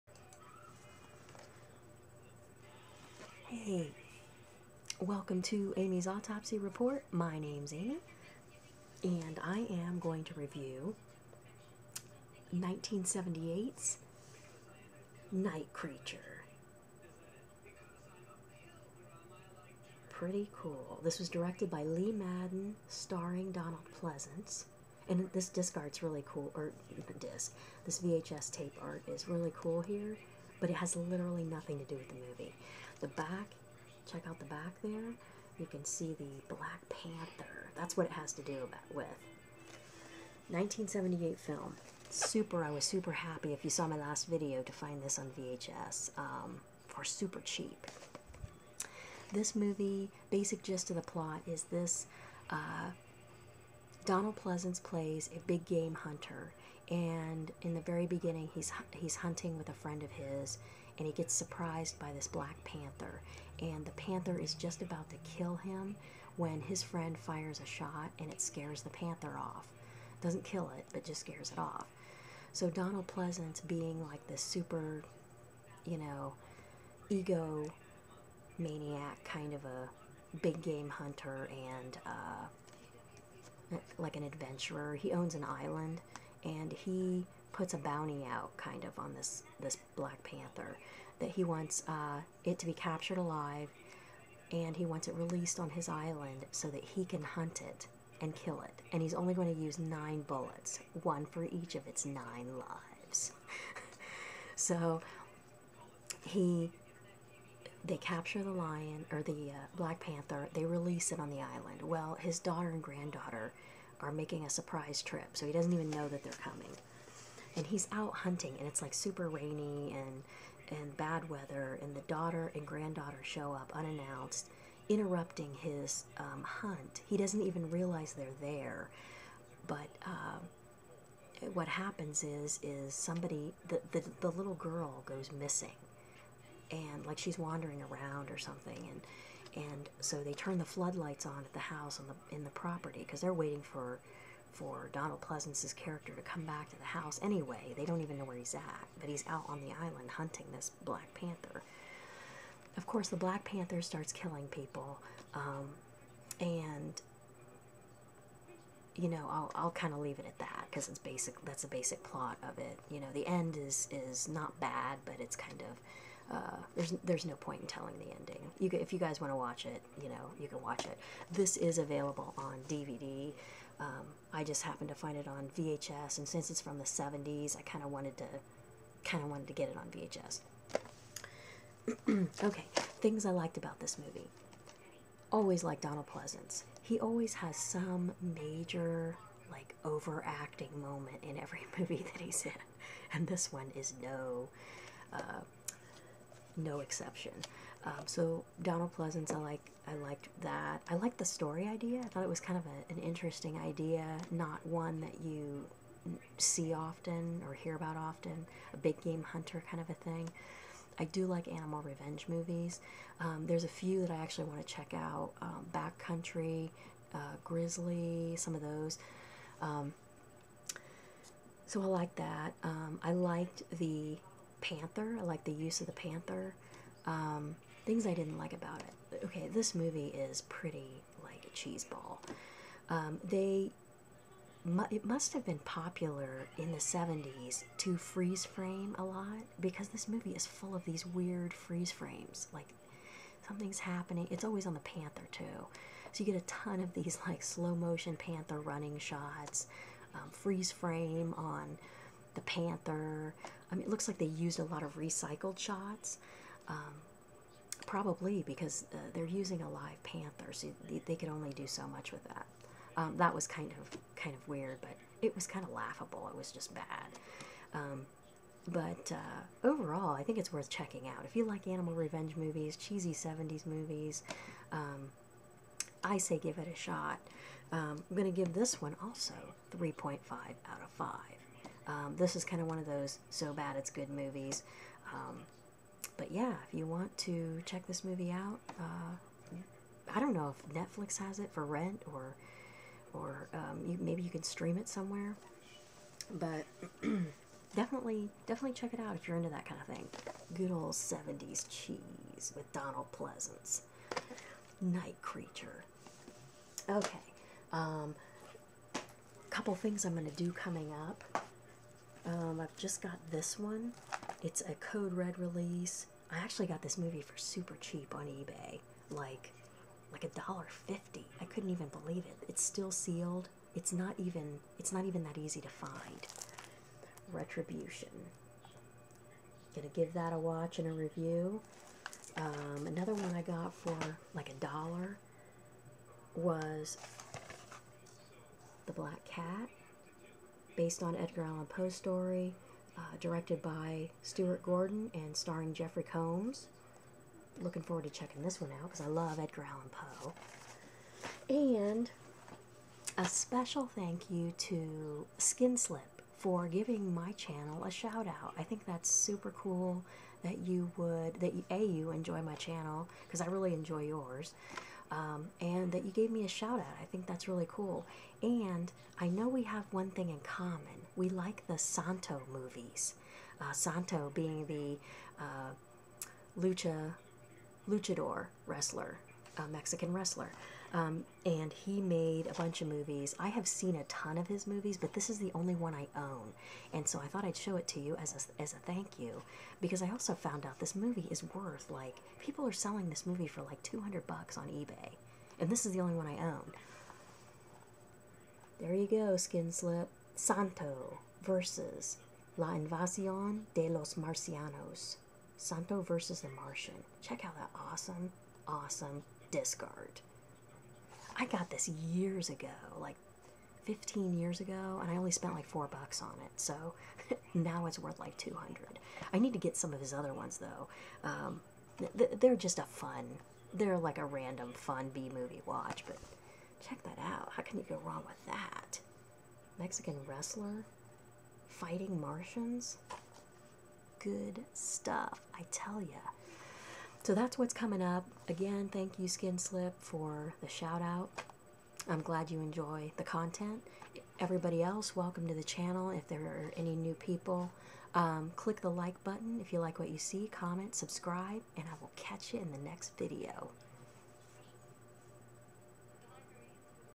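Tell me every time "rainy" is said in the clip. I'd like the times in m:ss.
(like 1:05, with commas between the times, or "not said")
1:59.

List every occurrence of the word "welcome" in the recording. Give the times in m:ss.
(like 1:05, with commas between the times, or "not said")
0:04, 7:25.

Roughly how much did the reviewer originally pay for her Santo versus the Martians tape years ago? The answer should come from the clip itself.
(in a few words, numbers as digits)
$4.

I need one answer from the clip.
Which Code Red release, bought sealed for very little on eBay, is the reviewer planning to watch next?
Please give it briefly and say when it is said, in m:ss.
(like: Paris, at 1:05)
Retribution, at 5:27.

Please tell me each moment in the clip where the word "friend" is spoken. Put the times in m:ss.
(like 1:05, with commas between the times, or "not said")
0:59, 1:06.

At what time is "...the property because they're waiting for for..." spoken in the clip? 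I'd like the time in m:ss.
2:22.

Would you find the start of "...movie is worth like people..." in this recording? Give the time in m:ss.
6:30.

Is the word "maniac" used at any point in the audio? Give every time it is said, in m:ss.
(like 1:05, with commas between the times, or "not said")
1:18.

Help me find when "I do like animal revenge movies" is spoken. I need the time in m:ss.
3:30.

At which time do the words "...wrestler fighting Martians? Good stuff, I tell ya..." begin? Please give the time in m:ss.
7:10.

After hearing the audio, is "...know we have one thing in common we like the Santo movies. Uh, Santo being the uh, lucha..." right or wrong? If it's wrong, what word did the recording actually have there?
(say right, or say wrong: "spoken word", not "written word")
right.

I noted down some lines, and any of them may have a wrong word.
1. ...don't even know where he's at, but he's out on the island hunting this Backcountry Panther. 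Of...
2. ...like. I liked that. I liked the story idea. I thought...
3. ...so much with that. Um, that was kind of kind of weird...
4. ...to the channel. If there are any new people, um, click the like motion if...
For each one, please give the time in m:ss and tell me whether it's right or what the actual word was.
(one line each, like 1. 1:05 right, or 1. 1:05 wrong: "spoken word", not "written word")
1. 2:27 wrong: "Black", not "Backcountry"
2. 3:19 right
3. 4:21 right
4. 7:25 wrong: "button", not "motion".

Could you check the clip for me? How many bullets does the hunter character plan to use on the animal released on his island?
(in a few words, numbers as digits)
9.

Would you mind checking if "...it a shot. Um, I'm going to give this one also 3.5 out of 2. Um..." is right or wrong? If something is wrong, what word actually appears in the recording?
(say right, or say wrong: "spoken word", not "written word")
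wrong: "5", not "2".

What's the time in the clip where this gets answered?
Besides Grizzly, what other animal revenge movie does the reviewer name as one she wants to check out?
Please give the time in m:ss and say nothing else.
3:35.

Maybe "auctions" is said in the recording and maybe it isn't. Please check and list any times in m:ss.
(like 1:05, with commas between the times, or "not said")
not said.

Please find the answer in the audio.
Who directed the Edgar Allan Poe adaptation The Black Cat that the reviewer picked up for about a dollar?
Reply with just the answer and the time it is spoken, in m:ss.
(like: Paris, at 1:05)
Stuart Gordon, at 5:44.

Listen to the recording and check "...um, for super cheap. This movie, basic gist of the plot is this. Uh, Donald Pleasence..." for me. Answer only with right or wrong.
right.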